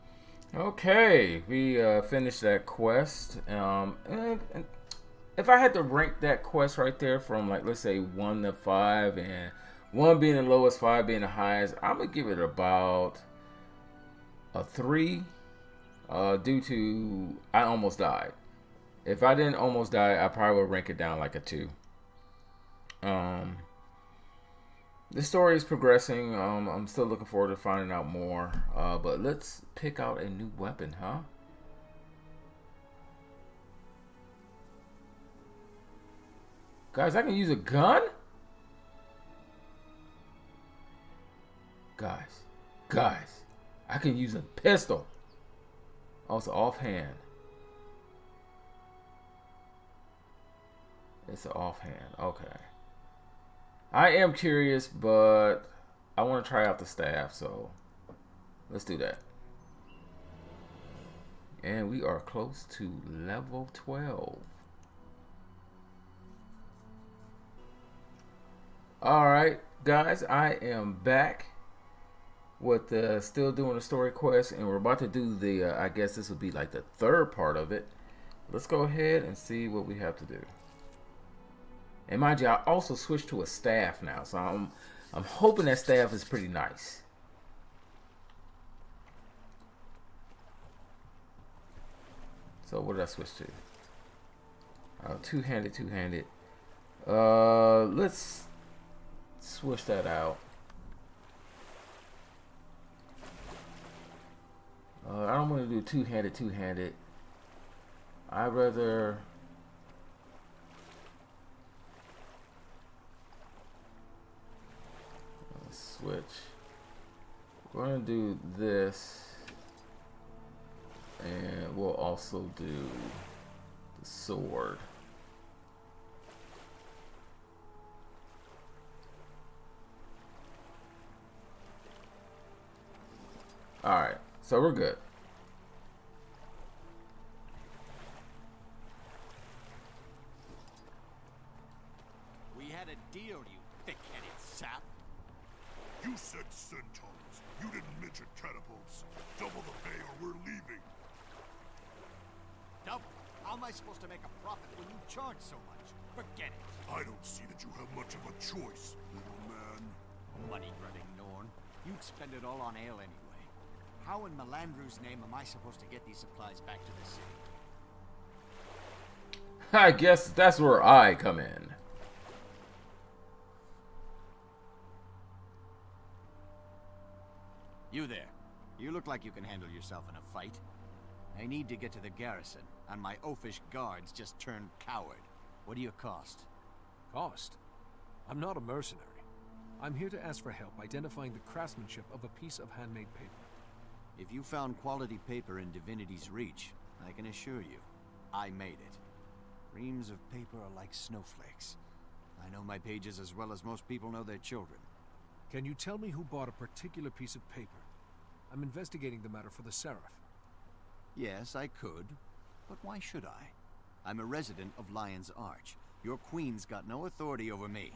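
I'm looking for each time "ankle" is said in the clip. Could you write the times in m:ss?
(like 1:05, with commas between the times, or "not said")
not said.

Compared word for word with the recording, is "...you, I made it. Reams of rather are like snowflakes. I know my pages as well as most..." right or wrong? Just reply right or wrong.
wrong.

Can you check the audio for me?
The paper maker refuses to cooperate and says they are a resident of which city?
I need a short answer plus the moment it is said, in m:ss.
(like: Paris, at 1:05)
Lion's Arch, at 3:34.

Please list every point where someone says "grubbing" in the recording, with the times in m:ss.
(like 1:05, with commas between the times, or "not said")
2:40.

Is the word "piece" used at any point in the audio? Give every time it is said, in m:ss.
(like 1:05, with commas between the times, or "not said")
3:12, 3:27.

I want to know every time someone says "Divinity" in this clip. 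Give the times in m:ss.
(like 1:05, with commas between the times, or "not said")
3:15.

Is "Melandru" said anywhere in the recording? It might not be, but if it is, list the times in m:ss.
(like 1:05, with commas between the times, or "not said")
2:44.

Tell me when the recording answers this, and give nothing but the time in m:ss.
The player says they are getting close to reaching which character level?
1:03.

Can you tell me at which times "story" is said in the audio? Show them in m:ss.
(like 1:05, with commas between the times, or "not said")
0:25, 1:13.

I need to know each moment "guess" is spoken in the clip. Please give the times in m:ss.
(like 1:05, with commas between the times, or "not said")
1:15, 2:49.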